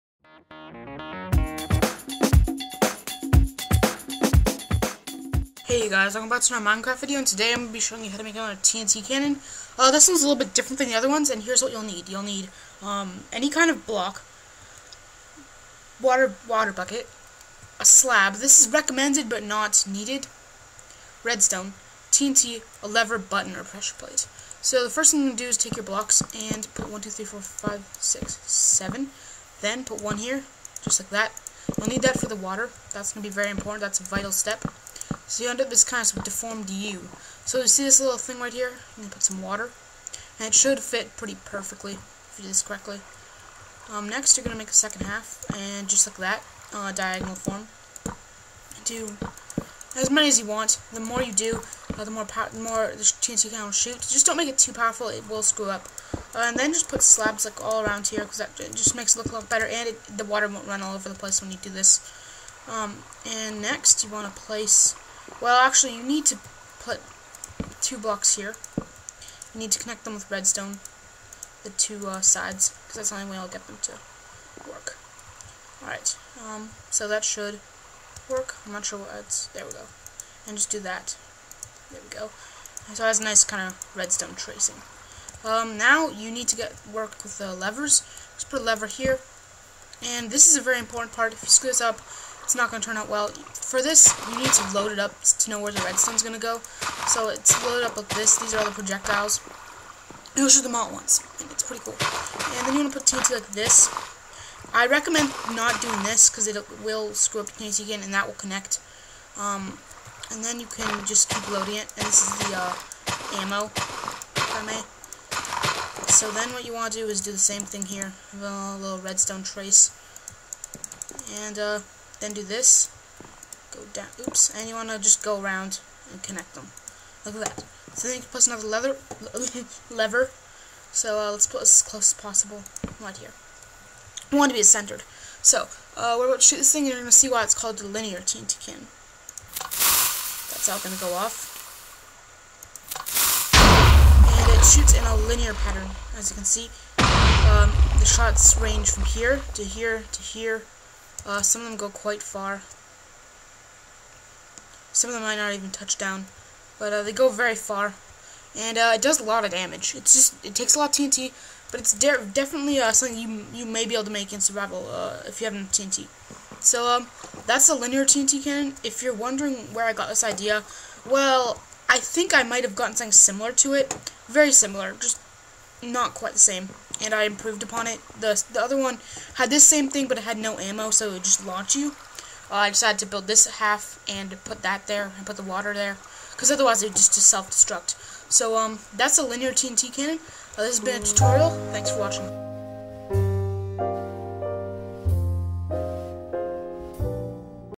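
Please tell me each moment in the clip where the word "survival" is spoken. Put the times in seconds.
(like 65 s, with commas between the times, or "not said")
164 s.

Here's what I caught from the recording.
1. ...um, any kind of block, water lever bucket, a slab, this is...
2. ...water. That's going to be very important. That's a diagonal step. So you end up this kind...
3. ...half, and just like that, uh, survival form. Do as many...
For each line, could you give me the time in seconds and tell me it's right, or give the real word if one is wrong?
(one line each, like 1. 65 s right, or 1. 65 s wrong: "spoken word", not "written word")
1. 12 s wrong: "water", not "lever"
2. 32 s wrong: "vital", not "diagonal"
3. 45 s wrong: "diagonal", not "survival".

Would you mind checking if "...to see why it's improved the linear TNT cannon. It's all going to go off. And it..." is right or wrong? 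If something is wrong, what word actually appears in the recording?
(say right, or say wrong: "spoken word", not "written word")
wrong: "called", not "improved".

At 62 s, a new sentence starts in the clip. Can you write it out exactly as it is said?
Um, and next, you want to place.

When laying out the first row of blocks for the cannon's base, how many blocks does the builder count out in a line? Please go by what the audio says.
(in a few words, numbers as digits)
7.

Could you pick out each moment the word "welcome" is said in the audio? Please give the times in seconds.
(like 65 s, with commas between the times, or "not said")
6 s.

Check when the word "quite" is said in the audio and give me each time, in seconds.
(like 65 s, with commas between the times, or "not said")
151 s, 176 s.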